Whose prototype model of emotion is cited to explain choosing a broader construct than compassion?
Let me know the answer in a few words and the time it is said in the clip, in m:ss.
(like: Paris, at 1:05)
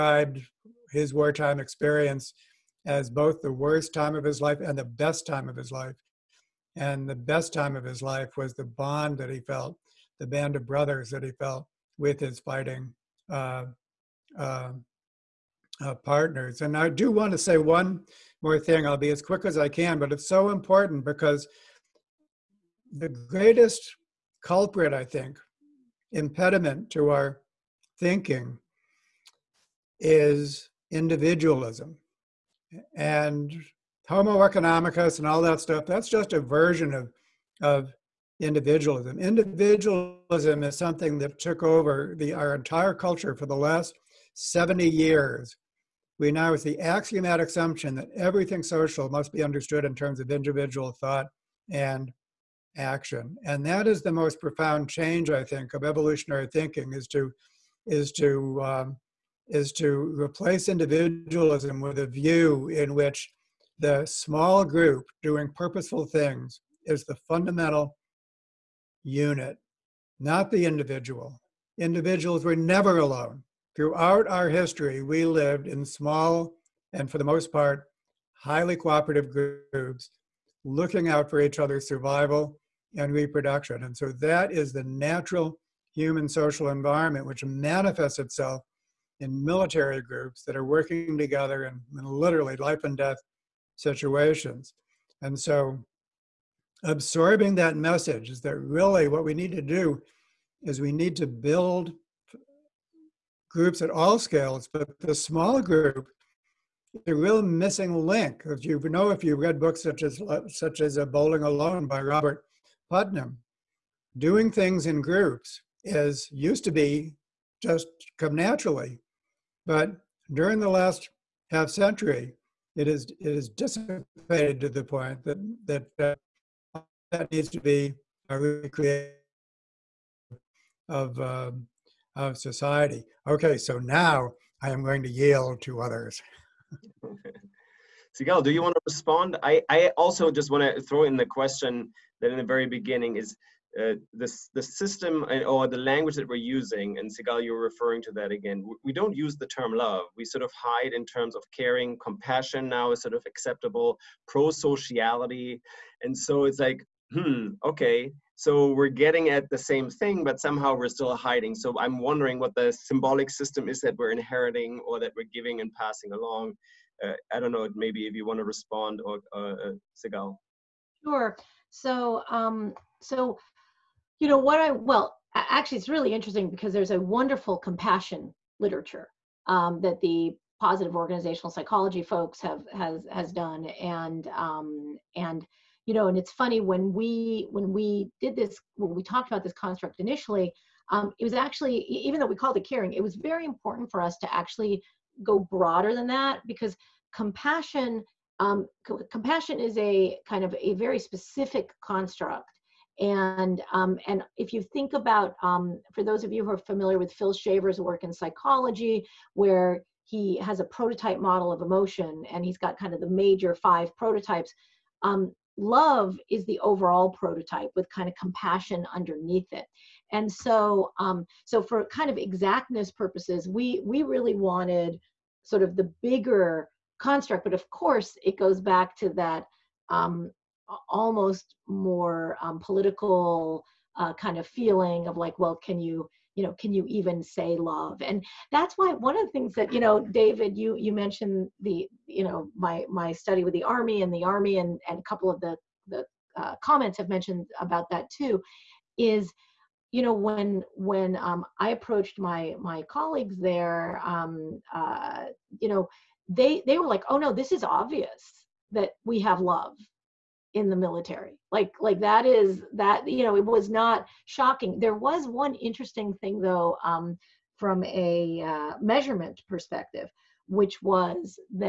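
Phil Shaver, at 3:27.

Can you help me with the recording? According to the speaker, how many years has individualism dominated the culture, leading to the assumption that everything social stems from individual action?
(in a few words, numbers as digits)
70.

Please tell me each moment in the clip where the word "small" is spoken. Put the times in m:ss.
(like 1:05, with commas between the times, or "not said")
1:04, 1:15, 1:45.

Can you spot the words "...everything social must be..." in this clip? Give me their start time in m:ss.
0:48.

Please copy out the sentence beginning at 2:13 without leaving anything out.
Okay, so now I am going to yield to others.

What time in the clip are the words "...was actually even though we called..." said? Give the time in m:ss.
3:11.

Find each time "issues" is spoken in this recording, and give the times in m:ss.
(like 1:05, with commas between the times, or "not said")
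not said.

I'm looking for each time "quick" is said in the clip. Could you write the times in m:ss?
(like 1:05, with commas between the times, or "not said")
0:19.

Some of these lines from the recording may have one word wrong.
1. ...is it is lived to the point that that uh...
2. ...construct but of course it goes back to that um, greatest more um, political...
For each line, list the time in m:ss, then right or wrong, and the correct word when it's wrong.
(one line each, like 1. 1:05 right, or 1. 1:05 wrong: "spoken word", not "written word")
1. 2:02 wrong: "dissipated", not "lived"
2. 3:46 wrong: "almost", not "greatest".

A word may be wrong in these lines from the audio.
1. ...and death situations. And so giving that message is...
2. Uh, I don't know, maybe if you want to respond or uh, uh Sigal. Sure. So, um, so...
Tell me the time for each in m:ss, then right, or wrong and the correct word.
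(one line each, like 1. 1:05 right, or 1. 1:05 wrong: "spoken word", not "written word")
1. 1:32 wrong: "absorbing", not "giving"
2. 2:47 right.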